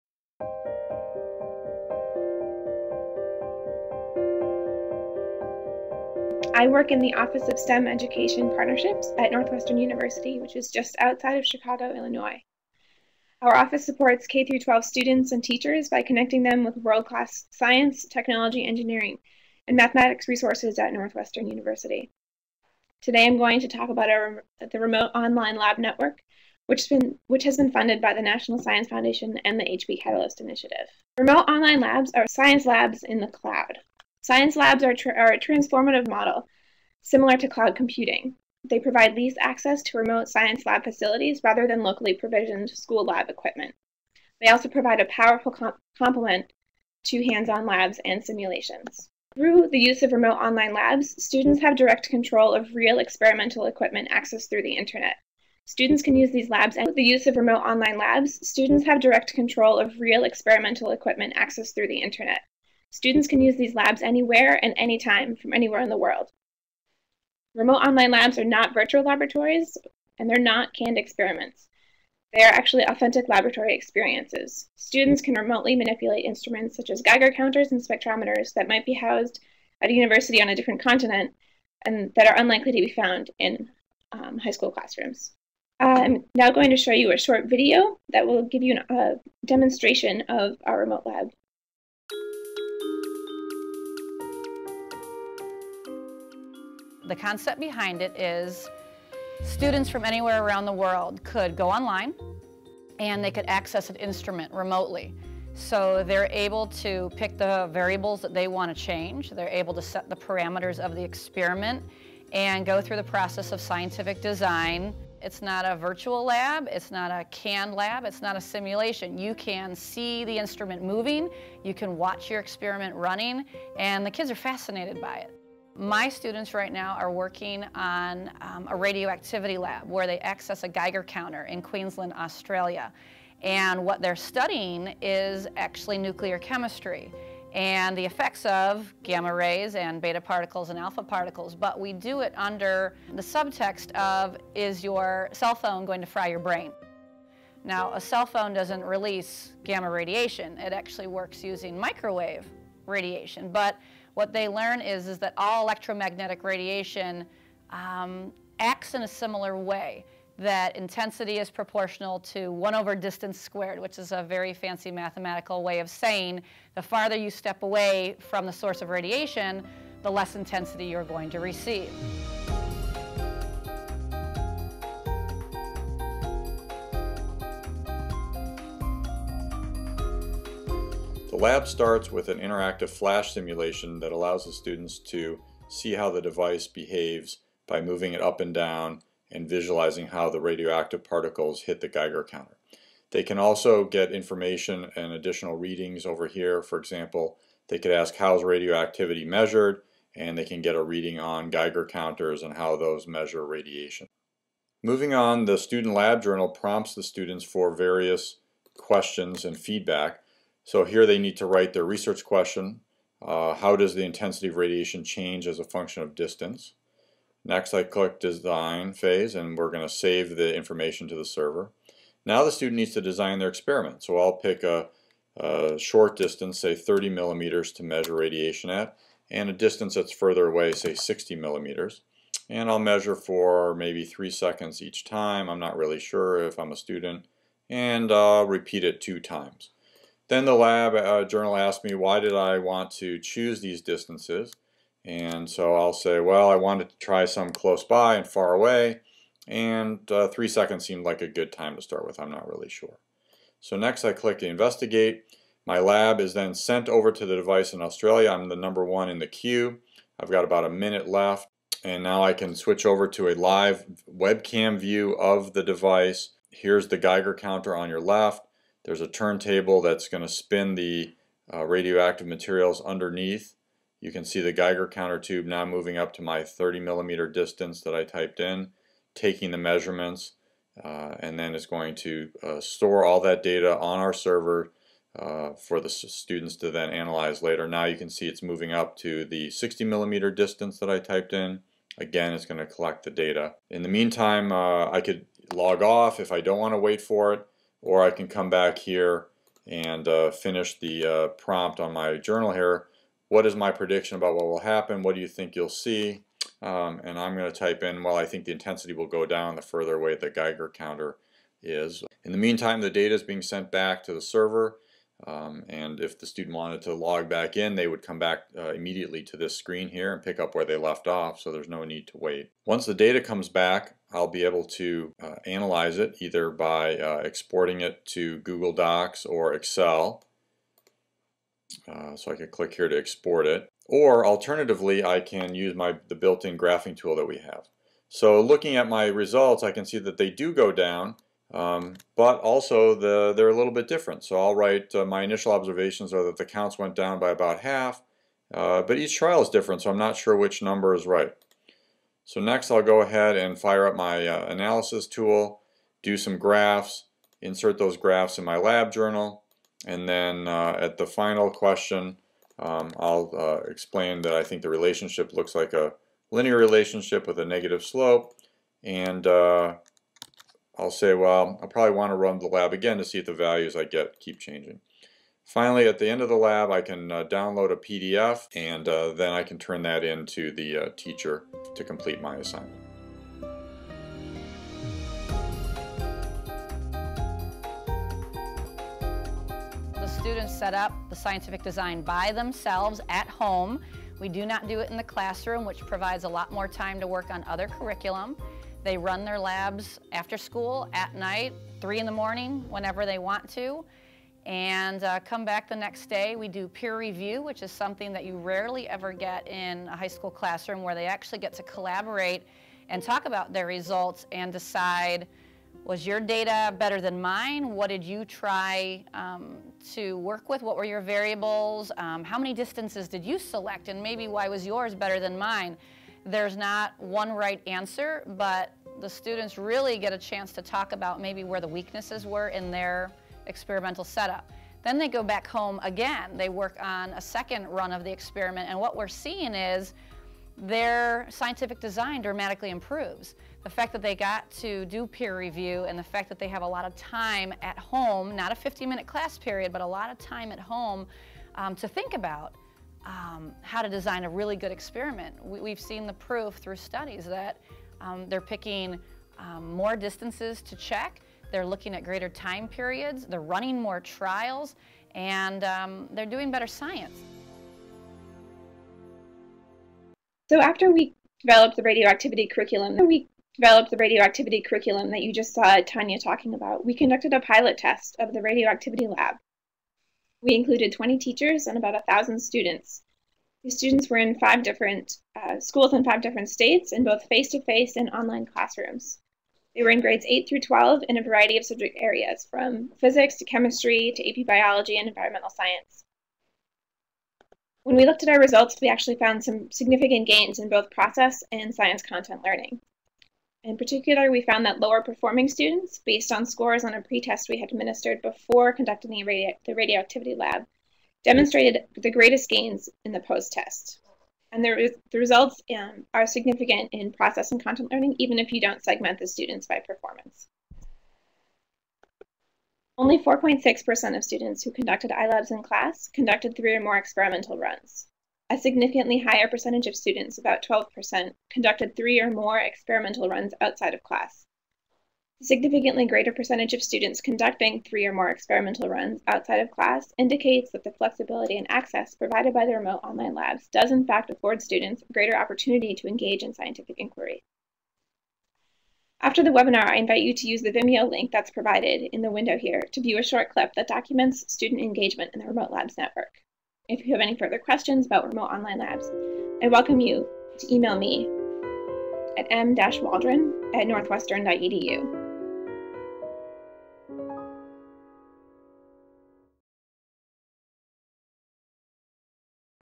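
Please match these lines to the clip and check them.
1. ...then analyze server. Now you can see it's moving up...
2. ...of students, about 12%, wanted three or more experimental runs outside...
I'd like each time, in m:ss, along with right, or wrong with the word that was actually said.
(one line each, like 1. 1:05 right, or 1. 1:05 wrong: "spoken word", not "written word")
1. 4:46 wrong: "later", not "server"
2. 8:49 wrong: "conducted", not "wanted".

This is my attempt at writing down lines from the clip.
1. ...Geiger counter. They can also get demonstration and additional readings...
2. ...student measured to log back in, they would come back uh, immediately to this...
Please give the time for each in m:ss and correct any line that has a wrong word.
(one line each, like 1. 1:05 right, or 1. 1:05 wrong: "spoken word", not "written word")
1. 3:11 wrong: "information", not "demonstration"
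2. 5:16 wrong: "wanted", not "measured".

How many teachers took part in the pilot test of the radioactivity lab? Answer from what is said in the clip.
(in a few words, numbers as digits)
20.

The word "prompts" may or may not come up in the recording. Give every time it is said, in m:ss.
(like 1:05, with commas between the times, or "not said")
3:26, 5:01.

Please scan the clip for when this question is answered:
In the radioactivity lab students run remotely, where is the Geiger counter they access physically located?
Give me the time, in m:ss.
2:11.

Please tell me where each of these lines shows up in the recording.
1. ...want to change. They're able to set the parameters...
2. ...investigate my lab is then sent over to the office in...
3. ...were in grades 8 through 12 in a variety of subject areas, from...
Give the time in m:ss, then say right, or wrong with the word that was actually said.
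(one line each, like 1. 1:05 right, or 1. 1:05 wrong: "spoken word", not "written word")
1. 1:48 right
2. 4:14 wrong: "device", not "office"
3. 8:09 right.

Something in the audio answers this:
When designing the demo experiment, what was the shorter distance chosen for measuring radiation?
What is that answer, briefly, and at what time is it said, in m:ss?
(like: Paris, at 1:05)
30 millimeters, at 3:46.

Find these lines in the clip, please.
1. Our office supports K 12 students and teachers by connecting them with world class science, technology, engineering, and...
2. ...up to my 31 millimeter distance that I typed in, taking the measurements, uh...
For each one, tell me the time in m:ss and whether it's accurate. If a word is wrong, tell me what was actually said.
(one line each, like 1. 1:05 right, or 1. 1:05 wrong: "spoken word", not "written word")
1. 0:13 right
2. 4:35 wrong: "30", not "31".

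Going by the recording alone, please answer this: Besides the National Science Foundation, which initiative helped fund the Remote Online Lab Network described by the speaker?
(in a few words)
HP Catalyst Initiative.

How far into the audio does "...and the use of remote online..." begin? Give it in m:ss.
0:56.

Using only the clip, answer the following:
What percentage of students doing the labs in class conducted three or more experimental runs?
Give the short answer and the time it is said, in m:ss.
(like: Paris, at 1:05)
4.6%, at 8:43.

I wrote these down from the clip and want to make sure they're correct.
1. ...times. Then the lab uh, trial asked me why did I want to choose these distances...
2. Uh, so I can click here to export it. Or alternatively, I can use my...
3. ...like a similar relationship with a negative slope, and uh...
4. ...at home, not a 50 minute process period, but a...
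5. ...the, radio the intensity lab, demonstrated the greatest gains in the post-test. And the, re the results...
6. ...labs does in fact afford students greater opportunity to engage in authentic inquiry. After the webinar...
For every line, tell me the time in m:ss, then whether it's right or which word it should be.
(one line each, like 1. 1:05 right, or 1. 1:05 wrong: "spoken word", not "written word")
1. 3:59 wrong: "journal", not "trial"
2. 5:31 right
3. 6:05 wrong: "linear", not "similar"
4. 7:27 wrong: "class", not "process"
5. 8:29 wrong: "radioactivity", not "intensity"
6. 9:03 wrong: "scientific", not "authentic".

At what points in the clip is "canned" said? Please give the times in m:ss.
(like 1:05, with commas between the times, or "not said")
1:10, 1:57.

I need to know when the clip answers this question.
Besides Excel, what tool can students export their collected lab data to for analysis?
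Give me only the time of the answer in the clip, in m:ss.
5:28.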